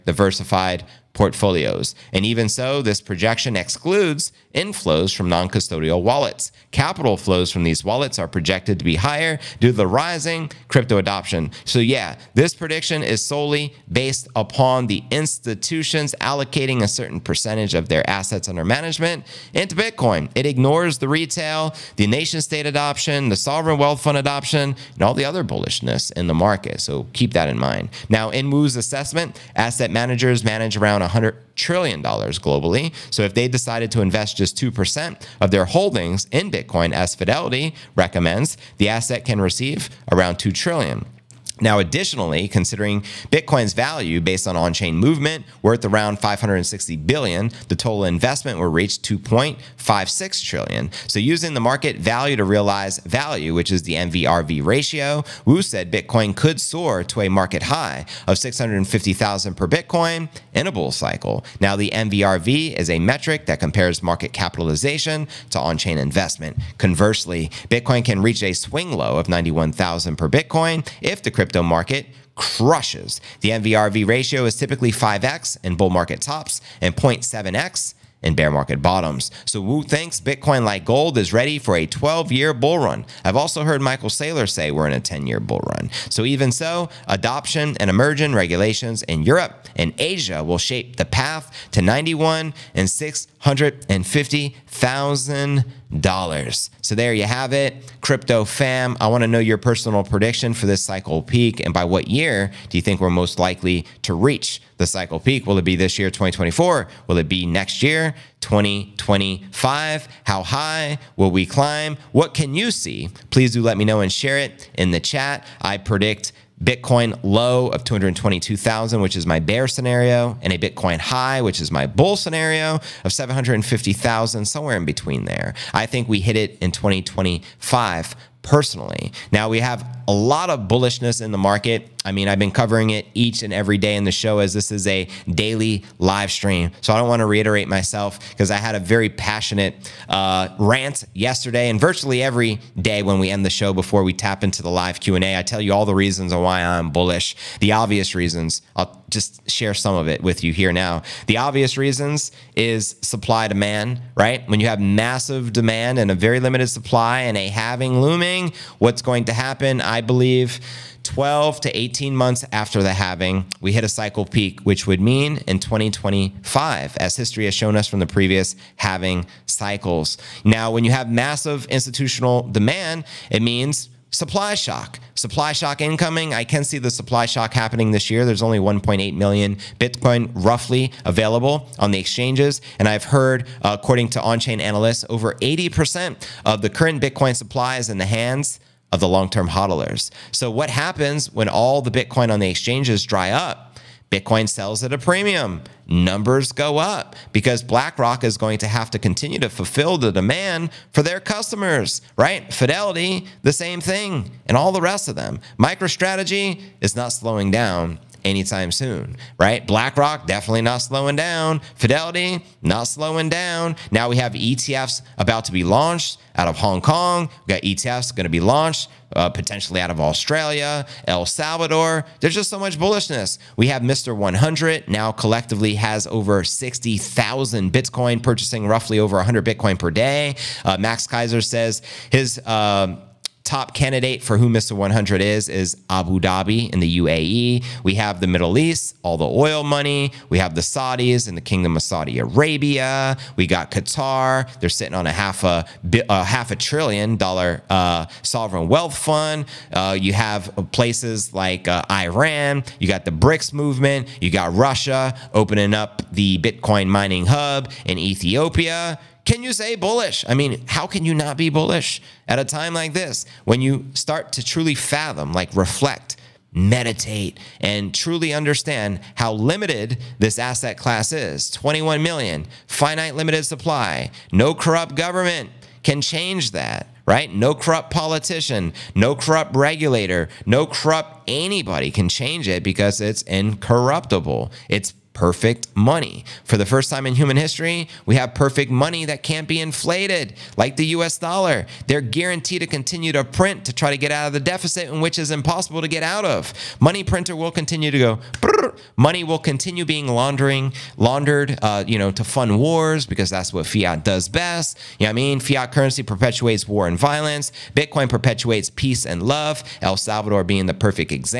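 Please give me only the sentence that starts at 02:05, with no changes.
I think we hit it in 2025 personally.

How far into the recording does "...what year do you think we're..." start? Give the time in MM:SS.
01:41.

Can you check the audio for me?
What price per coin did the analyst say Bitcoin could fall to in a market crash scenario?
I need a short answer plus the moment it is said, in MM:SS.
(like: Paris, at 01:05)
$91,000, at 01:09.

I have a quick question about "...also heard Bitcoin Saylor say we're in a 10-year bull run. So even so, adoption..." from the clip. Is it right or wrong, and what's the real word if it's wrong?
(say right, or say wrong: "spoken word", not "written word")
wrong: "Michael", not "Bitcoin".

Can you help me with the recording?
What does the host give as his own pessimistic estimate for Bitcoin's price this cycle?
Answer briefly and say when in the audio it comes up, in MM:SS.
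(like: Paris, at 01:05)
$222,000, at 01:57.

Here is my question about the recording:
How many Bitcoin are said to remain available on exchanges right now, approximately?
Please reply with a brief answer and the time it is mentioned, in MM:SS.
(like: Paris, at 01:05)
1.8 million, at 02:58.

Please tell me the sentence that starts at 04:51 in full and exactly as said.
They're guaranteed to continue to print to try to get out of the deficit, in which is impossible to get out of.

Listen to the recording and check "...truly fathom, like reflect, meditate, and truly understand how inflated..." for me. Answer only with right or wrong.
wrong.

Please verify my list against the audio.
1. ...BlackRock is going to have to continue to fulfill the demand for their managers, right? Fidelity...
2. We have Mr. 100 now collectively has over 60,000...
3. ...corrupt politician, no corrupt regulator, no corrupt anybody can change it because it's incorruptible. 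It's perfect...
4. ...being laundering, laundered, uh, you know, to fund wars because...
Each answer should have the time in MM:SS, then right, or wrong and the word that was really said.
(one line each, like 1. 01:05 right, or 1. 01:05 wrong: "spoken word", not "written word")
1. 03:17 wrong: "customers", not "managers"
2. 03:43 right
3. 04:37 right
4. 04:59 right.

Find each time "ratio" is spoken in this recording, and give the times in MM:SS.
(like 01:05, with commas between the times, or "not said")
00:54, 01:14.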